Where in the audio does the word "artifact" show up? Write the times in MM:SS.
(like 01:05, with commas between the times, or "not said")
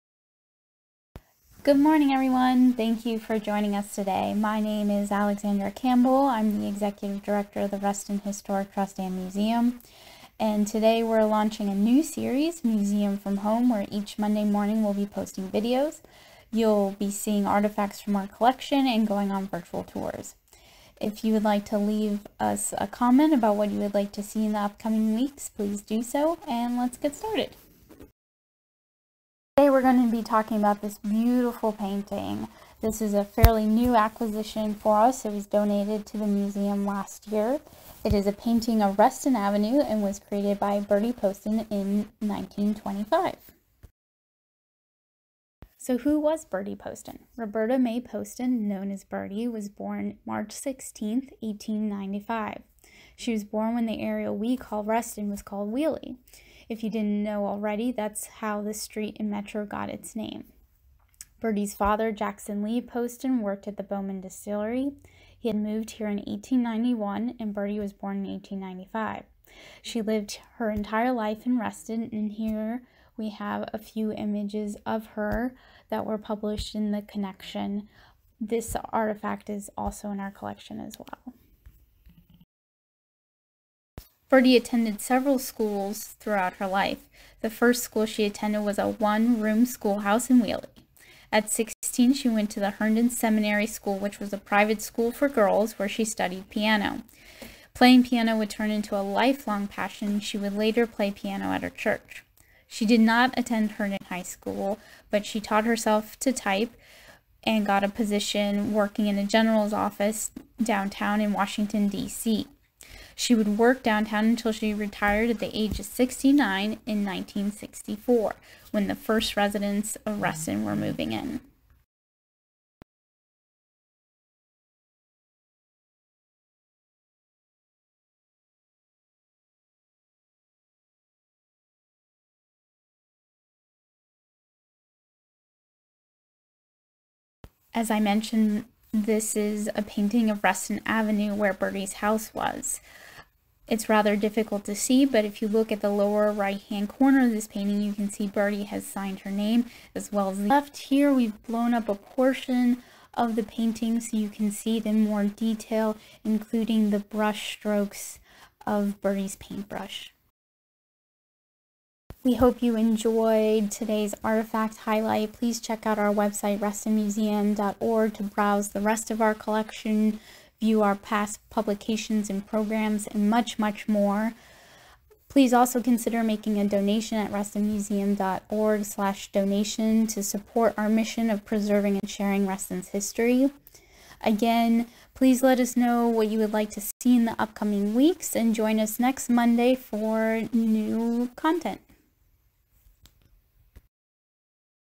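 00:17, 01:18, 02:44.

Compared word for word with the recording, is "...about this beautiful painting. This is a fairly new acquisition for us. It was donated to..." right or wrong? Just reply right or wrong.
right.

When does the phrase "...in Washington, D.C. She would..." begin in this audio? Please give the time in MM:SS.
01:51.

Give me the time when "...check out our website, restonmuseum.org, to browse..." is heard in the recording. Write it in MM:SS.
02:45.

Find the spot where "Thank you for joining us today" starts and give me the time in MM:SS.
00:02.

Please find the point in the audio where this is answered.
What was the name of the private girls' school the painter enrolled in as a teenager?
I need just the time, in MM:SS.
01:32.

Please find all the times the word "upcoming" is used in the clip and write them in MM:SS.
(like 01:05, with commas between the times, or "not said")
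00:24, 03:07.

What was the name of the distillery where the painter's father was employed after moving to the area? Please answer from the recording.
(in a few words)
Bowman Distillery.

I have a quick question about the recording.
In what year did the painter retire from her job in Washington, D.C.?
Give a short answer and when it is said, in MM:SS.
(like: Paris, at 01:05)
1964, at 01:57.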